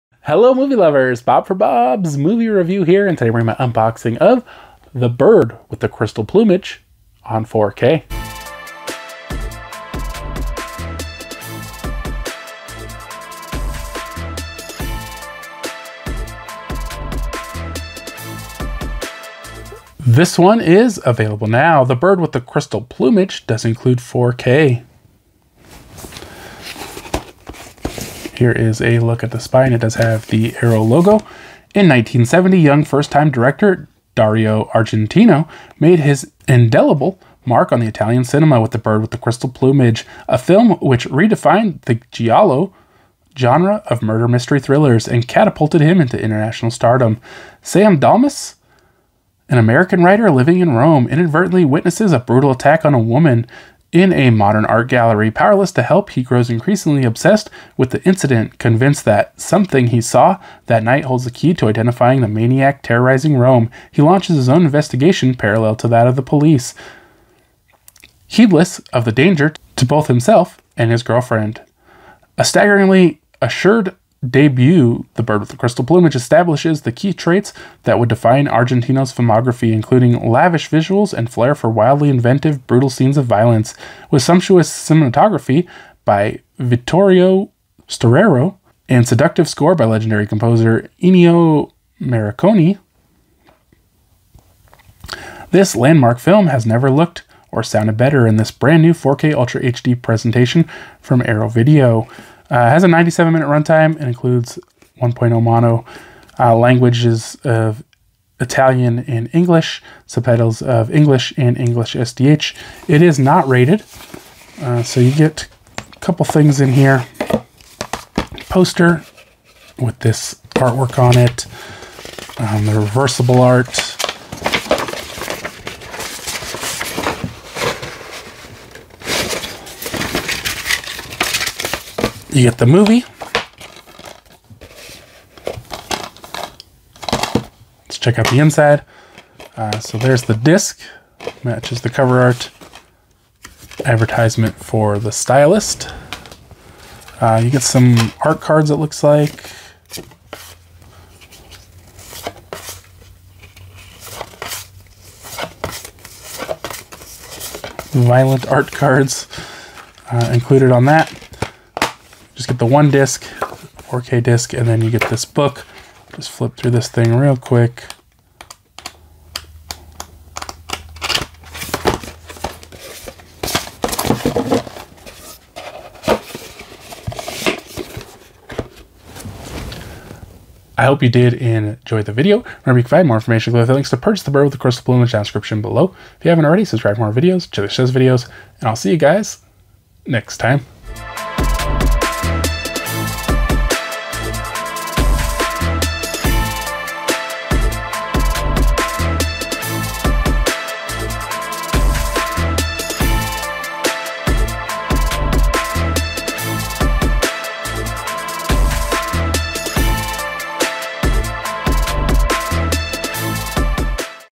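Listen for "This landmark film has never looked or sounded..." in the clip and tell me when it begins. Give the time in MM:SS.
01:35.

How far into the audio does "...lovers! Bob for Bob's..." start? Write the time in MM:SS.
00:00.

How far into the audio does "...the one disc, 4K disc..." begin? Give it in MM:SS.
02:42.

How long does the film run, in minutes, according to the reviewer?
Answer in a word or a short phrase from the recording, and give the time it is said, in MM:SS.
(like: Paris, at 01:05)
97, at 01:42.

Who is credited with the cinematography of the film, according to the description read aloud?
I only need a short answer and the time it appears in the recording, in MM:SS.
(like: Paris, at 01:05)
Vittorio Storaro, at 01:26.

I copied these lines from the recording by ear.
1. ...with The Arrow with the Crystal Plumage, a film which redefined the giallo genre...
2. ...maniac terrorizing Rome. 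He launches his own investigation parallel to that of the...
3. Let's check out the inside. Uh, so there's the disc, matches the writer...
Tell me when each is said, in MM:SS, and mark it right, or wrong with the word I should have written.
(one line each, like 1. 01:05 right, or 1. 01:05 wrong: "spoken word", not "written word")
1. 00:38 wrong: "Bird", not "Arrow"
2. 01:02 right
3. 02:17 wrong: "cover", not "writer".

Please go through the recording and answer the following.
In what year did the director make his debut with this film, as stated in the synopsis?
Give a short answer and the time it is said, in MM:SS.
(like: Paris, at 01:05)
1970, at 00:31.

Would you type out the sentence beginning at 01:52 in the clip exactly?
It is not rated, uh, so you get a couple things in here.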